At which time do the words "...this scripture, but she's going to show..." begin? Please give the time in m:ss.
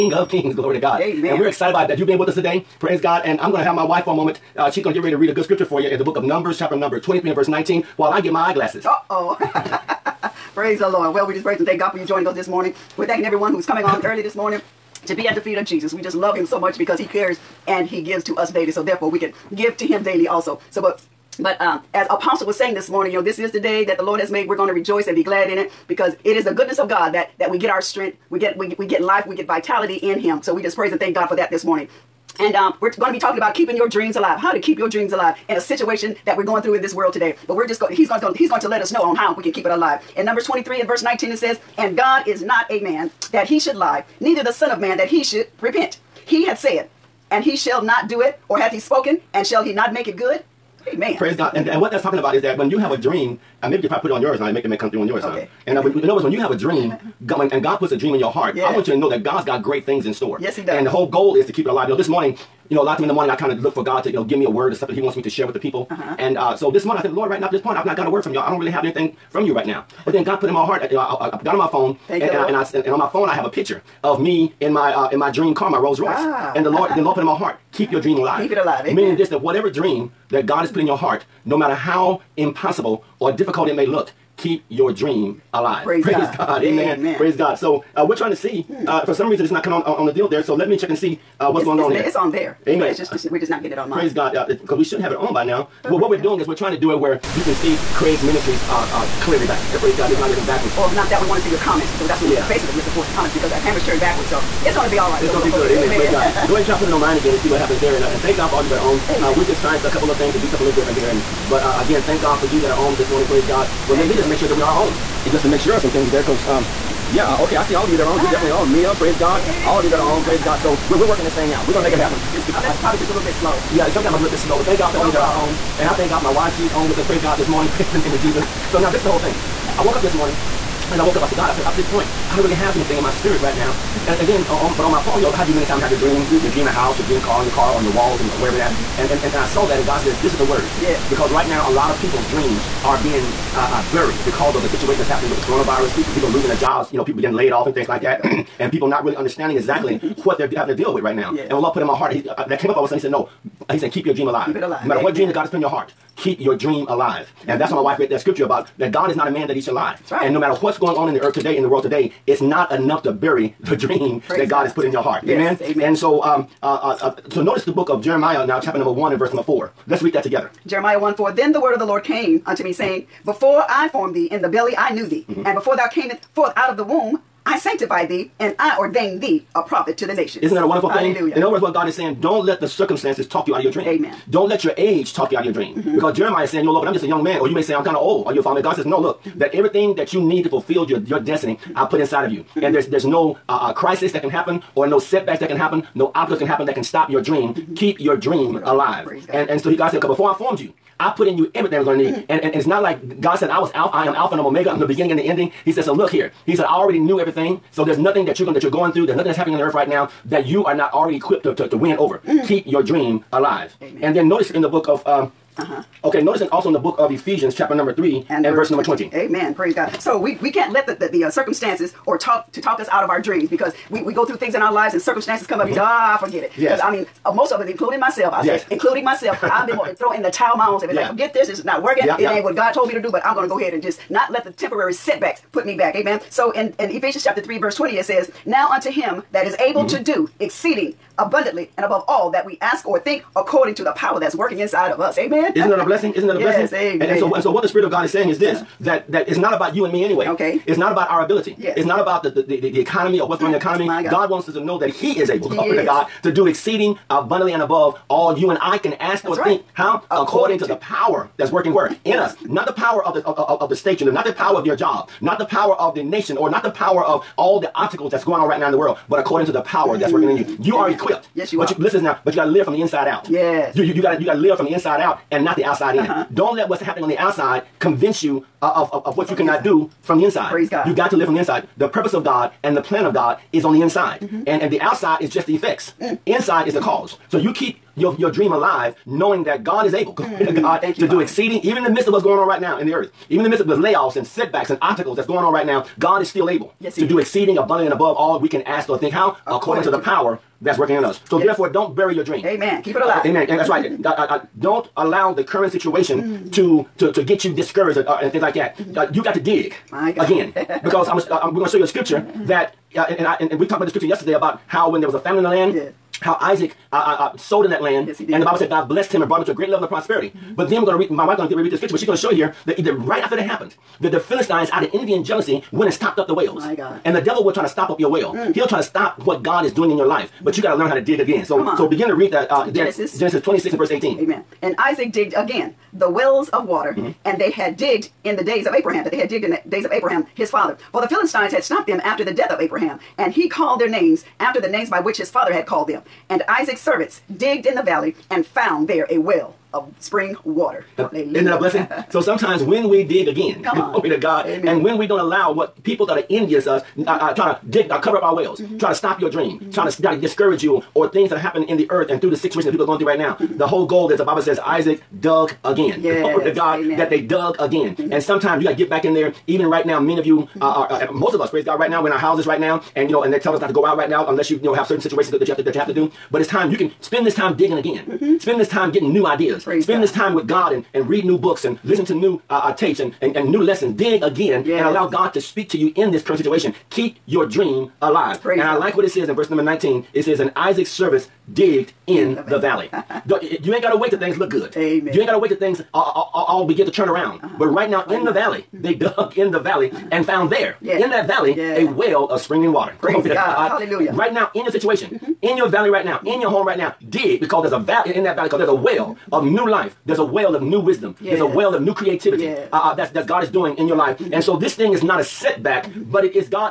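5:21.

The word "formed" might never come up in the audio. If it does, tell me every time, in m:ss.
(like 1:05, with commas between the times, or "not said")
2:53, 3:20.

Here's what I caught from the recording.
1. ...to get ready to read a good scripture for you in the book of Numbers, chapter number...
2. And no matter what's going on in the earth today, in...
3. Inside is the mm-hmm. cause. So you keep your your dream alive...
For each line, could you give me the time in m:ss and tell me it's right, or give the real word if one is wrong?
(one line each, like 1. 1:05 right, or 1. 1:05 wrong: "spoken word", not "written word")
1. 0:04 right
2. 2:40 right
3. 4:46 right.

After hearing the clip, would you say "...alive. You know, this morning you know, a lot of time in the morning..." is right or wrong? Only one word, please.
right.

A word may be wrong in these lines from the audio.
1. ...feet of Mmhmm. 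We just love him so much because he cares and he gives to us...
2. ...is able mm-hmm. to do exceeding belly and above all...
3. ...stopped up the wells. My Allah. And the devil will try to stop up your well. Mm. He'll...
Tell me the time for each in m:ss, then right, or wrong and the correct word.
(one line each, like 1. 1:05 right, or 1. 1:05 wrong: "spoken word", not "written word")
1. 0:15 wrong: "Jesus", not "Mmhmm"
2. 3:59 wrong: "abundantly", not "belly"
3. 5:25 wrong: "God", not "Allah".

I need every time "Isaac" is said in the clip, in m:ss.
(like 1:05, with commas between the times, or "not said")
5:16, 5:34, 5:46, 6:04, 6:30.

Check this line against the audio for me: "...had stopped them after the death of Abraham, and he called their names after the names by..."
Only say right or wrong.
right.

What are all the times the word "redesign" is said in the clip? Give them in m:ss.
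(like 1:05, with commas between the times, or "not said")
not said.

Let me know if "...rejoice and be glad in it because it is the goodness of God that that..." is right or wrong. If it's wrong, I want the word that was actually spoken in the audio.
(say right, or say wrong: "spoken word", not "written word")
right.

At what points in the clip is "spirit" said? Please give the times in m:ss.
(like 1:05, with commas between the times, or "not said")
2:13, 4:07.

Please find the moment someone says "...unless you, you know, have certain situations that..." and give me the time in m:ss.
6:14.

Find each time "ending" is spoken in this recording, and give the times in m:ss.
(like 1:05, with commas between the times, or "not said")
3:25.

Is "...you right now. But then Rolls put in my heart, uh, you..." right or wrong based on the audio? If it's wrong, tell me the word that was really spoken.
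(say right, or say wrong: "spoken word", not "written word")
wrong: "God", not "Rolls".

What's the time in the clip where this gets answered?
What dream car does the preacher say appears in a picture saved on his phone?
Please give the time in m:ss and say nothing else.
1:15.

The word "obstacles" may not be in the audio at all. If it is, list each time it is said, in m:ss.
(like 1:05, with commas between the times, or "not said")
3:16, 4:27, 4:54.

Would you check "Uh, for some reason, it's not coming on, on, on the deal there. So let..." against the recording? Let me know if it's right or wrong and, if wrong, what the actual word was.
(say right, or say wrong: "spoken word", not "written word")
right.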